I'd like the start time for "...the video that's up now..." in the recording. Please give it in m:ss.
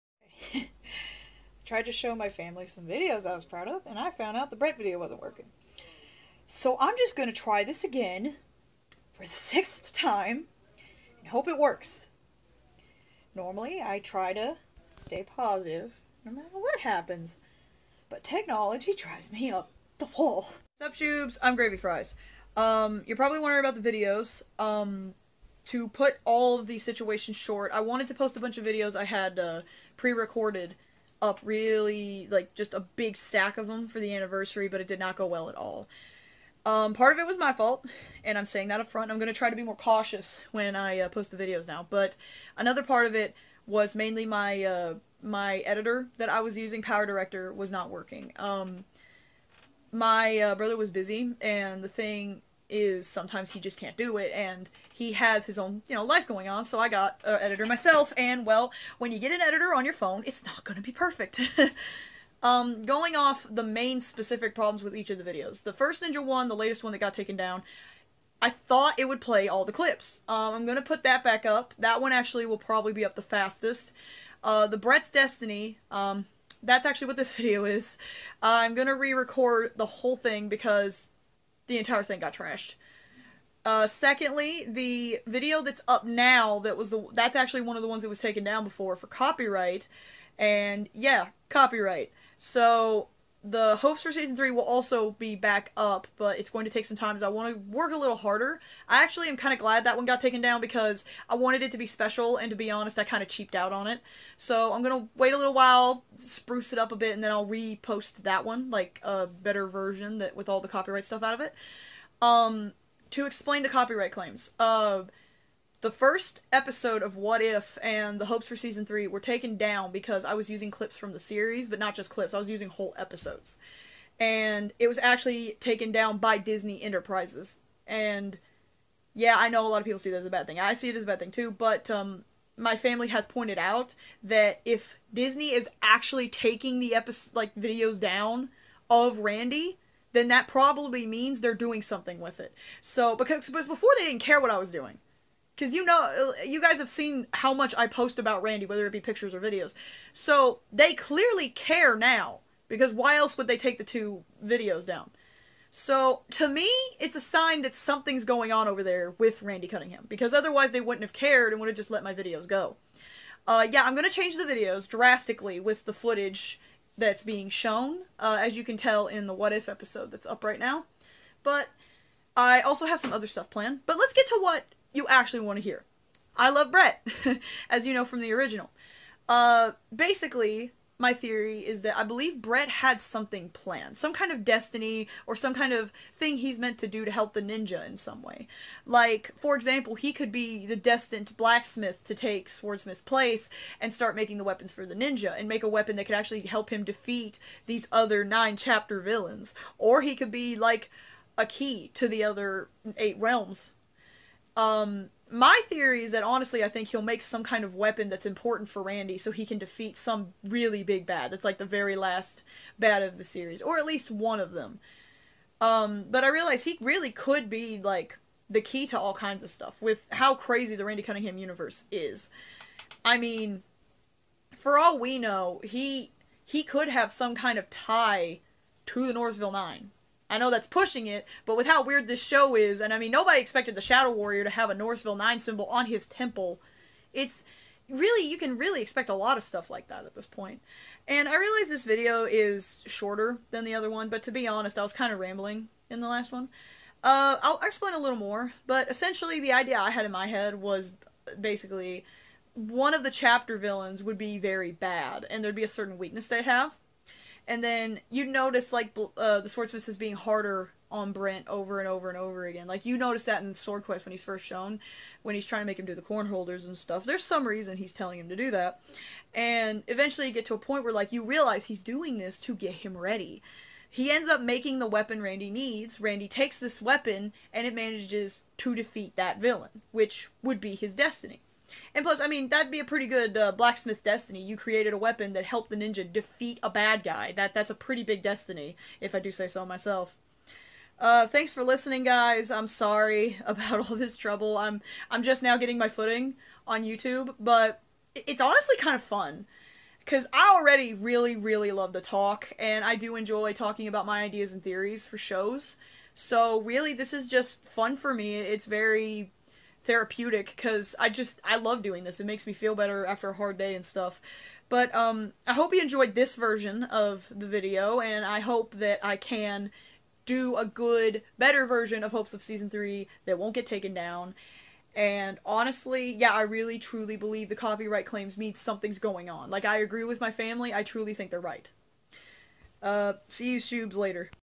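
1:24.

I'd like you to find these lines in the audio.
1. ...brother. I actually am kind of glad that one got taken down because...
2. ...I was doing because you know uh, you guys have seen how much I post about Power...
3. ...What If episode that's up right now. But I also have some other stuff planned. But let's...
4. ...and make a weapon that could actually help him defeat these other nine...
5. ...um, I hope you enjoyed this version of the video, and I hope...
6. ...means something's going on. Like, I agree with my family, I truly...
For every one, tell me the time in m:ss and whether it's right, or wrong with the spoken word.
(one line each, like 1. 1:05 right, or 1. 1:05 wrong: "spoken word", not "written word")
1. 1:38 wrong: "harder", not "brother"
2. 2:24 wrong: "Randy", not "Power"
3. 2:49 right
4. 3:15 right
5. 5:14 right
6. 5:28 right.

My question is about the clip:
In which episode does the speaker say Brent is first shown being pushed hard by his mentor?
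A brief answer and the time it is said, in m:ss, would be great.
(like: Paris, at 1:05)
Sword Quest, at 4:23.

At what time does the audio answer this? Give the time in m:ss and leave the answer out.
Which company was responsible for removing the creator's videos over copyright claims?
2:06.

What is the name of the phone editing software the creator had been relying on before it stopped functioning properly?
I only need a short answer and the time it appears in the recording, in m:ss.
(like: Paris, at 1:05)
Power Director, at 0:46.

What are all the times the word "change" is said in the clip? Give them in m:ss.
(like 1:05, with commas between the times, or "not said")
2:44.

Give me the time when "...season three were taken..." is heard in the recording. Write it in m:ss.
1:58.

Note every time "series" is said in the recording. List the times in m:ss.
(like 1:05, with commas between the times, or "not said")
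2:01, 3:33.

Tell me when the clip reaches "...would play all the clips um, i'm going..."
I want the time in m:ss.
1:09.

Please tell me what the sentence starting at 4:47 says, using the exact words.
That that's a pretty big destiny, if I do say so myself.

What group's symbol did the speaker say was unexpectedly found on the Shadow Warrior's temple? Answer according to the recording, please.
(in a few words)
Norrisville Nine.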